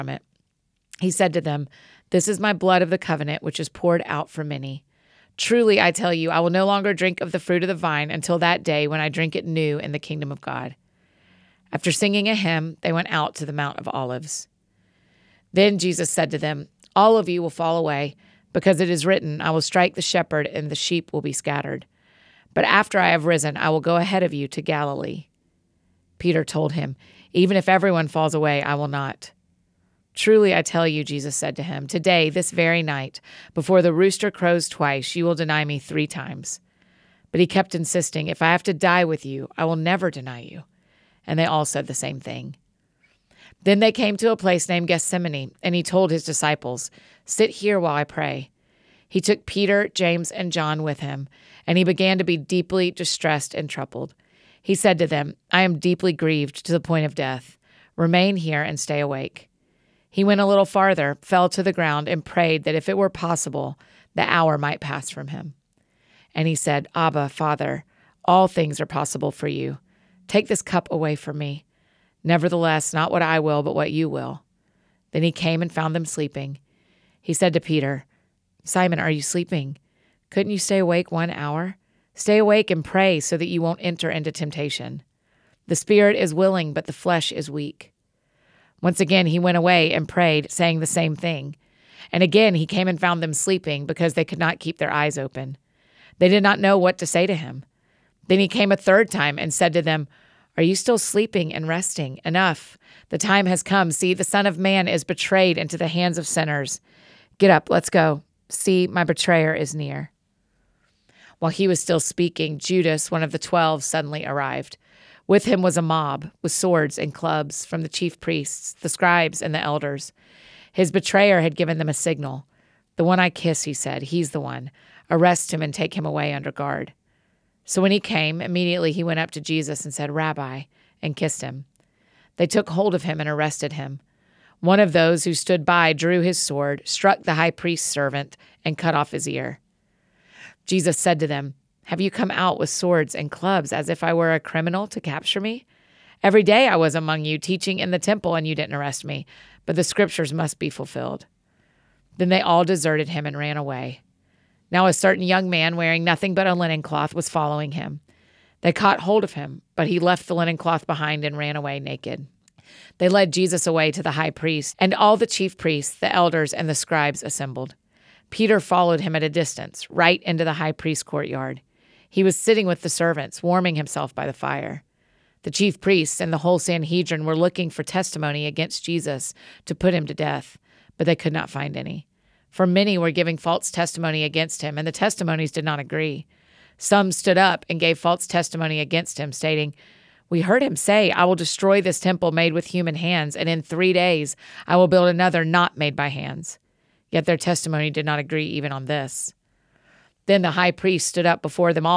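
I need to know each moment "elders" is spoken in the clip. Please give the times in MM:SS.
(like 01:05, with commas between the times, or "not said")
01:59, 02:46.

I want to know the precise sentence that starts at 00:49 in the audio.
He took Peter, James, and John with him, and he began to be deeply distressed and troubled.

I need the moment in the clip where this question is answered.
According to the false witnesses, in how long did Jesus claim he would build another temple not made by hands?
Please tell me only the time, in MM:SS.
03:13.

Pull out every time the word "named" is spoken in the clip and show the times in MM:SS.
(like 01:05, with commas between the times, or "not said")
00:44.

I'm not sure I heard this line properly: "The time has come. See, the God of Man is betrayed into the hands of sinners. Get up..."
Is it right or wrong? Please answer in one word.
wrong.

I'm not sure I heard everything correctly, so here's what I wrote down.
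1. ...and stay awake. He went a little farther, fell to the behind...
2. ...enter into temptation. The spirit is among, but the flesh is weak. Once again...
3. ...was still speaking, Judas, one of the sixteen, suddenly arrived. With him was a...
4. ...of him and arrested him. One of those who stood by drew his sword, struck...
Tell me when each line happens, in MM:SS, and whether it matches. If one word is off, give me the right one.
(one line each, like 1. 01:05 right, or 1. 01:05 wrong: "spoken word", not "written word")
1. 00:58 wrong: "ground", not "behind"
2. 01:23 wrong: "willing", not "among"
3. 01:51 wrong: "twelve", not "sixteen"
4. 02:12 right.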